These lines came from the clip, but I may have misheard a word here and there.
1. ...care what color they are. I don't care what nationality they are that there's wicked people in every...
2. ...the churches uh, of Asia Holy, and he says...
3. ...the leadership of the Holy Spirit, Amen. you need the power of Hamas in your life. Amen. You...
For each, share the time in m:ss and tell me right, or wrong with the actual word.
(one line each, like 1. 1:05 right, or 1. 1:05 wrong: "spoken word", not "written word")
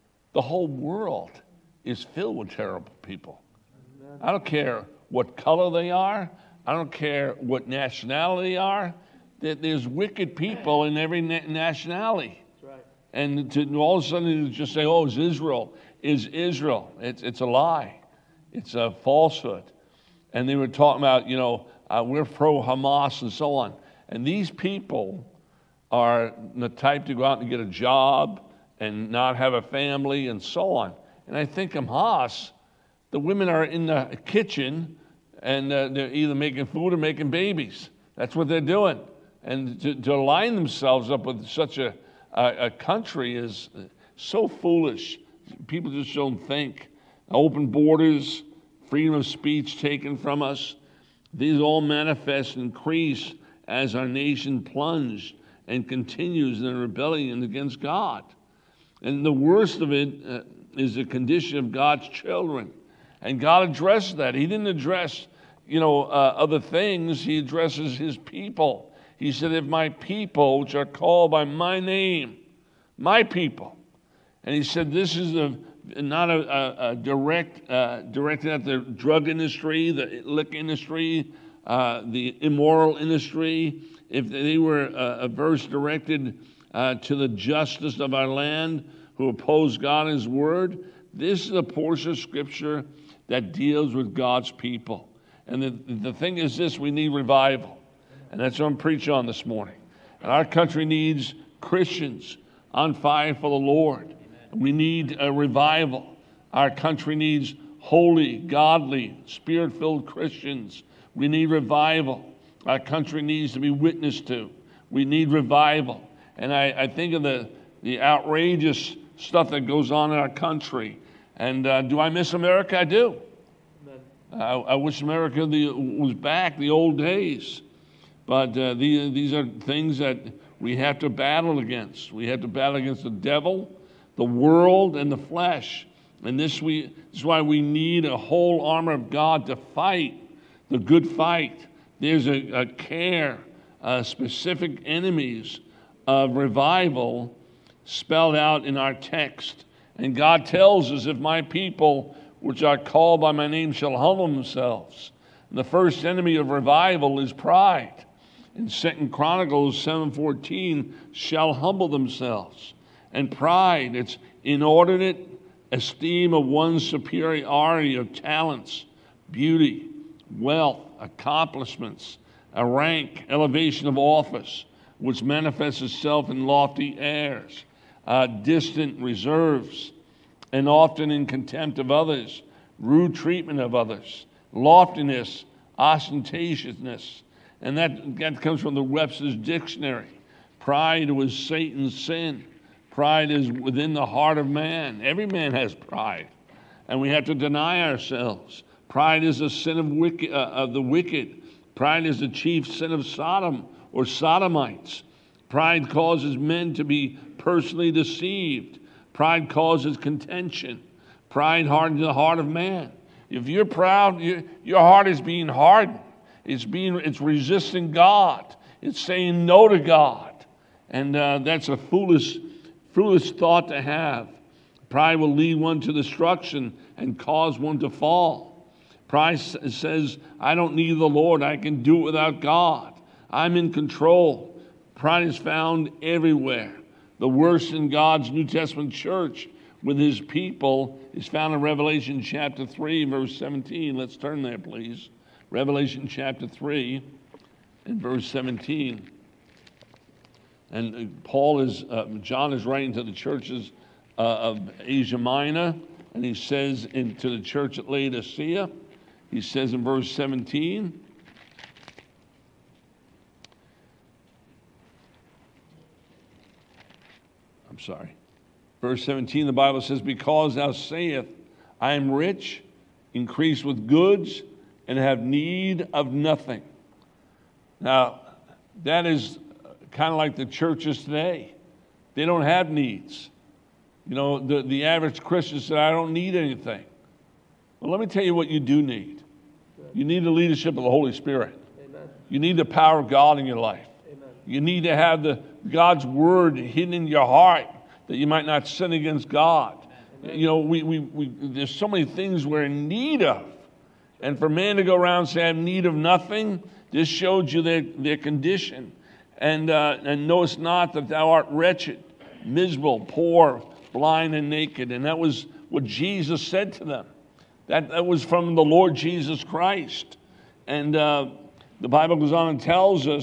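1. 0:04 right
2. 4:13 wrong: "Minor", not "Holy"
3. 4:50 wrong: "God", not "Hamas".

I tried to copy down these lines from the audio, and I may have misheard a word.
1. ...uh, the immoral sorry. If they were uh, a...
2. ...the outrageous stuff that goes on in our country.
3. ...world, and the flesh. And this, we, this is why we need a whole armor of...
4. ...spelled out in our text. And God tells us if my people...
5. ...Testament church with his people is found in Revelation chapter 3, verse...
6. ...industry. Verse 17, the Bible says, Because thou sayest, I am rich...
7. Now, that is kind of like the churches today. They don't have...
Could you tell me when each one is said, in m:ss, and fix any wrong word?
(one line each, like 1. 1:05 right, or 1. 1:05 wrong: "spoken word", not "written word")
1. 1:21 wrong: "industry", not "sorry"
2. 1:57 right
3. 2:14 right
4. 2:27 right
5. 3:58 right
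6. 4:27 wrong: "sorry", not "industry"
7. 4:37 right.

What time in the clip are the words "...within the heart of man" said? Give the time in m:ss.
3:13.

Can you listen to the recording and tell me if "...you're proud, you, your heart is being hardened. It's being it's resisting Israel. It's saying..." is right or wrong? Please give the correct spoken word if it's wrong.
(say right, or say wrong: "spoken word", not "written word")
wrong: "God", not "Israel".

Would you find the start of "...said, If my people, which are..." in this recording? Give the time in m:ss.
1:09.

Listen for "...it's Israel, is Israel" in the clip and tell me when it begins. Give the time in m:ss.
0:15.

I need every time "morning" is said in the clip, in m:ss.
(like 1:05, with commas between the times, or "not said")
1:39.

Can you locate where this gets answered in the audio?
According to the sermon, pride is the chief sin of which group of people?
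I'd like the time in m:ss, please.
3:23.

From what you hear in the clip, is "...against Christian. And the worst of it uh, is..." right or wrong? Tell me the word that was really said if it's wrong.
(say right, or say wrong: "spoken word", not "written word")
wrong: "God", not "Christian".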